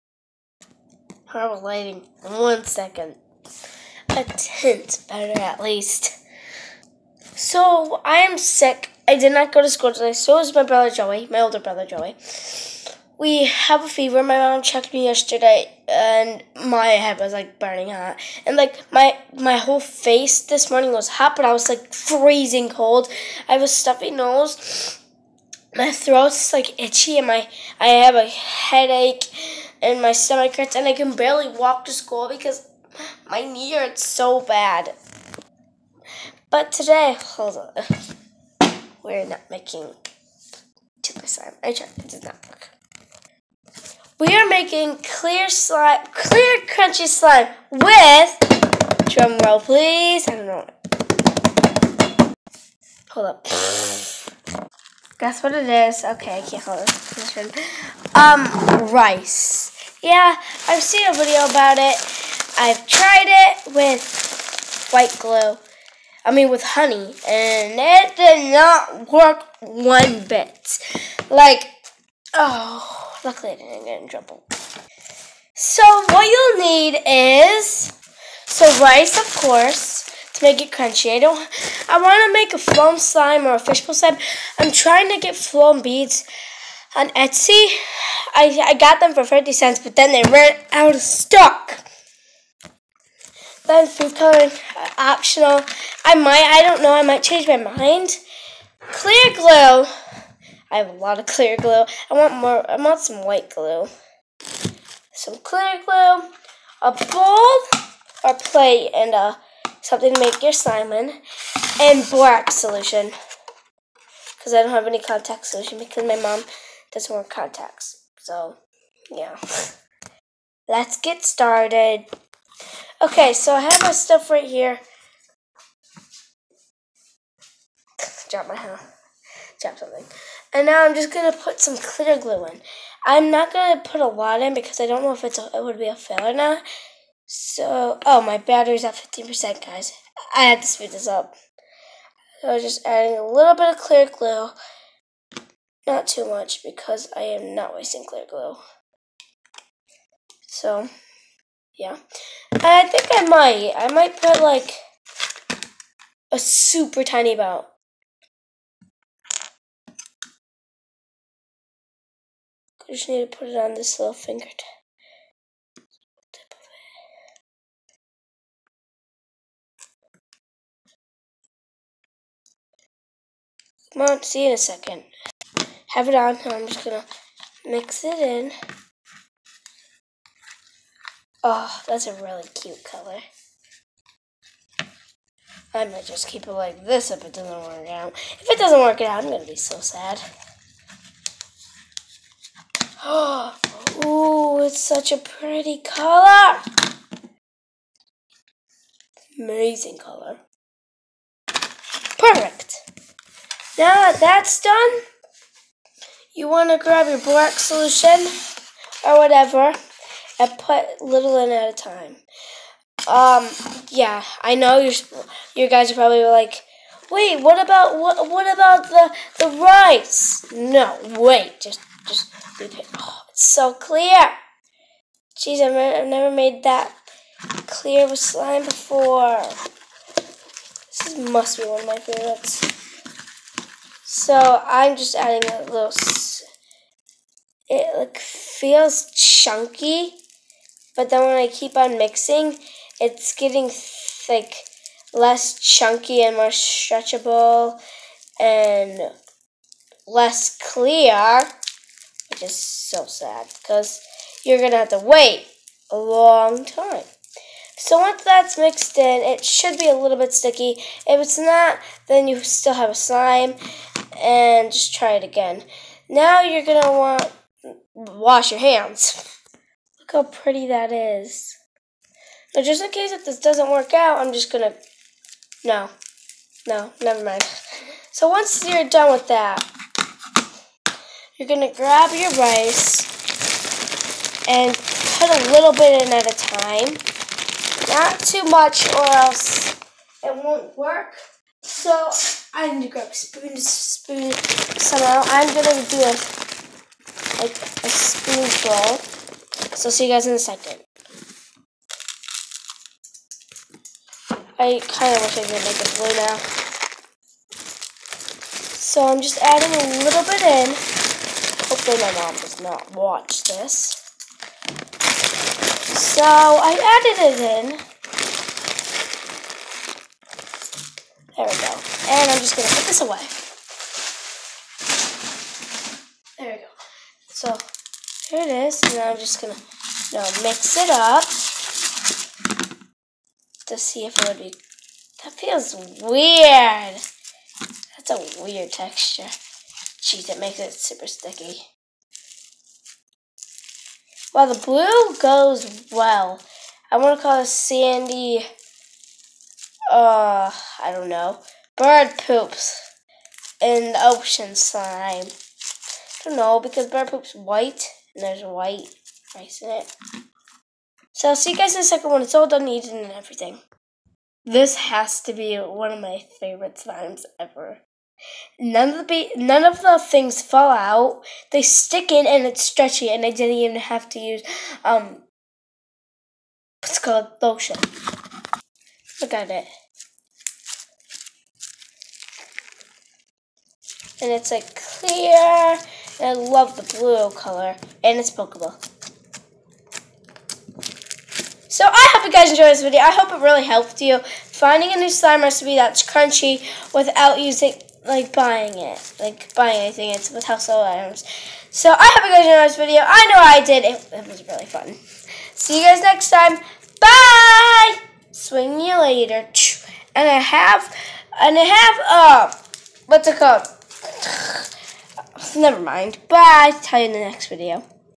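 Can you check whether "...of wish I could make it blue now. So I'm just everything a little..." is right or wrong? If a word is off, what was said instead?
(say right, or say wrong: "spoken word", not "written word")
wrong: "adding", not "everything".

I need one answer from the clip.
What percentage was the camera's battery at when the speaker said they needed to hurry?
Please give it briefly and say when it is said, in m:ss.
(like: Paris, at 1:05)
15%, at 2:18.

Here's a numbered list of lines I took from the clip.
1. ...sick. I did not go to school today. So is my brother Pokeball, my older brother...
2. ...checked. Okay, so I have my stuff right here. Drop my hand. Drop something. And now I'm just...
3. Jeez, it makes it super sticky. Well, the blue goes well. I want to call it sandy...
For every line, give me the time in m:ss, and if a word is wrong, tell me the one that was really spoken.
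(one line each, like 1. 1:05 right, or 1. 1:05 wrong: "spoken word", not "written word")
1. 0:08 wrong: "Joey", not "Pokeball"
2. 2:01 wrong: "started", not "checked"
3. 5:40 right.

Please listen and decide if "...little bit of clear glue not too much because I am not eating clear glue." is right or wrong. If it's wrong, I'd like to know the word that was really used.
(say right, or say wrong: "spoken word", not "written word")
wrong: "wasting", not "eating".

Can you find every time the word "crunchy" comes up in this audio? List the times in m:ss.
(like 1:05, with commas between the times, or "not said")
0:46, 1:20, 6:36.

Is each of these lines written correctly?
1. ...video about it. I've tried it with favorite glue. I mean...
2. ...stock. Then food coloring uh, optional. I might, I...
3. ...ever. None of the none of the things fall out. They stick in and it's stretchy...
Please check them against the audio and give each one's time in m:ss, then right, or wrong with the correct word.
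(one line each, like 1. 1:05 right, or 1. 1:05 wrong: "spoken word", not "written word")
1. 1:01 wrong: "white", not "favorite"
2. 1:31 right
3. 6:07 right.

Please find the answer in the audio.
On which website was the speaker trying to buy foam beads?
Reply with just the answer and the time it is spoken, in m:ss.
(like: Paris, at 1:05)
Etsy, at 1:27.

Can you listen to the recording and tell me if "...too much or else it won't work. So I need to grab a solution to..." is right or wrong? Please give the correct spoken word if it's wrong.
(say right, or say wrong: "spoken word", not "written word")
wrong: "spoon", not "solution".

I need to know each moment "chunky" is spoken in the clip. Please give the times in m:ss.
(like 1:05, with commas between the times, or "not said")
3:59, 4:05.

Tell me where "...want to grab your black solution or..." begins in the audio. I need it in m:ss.
3:26.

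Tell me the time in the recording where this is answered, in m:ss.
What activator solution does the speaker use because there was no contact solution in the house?
1:52.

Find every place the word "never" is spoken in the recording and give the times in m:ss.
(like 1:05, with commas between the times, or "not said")
3:46, 4:37, 6:55.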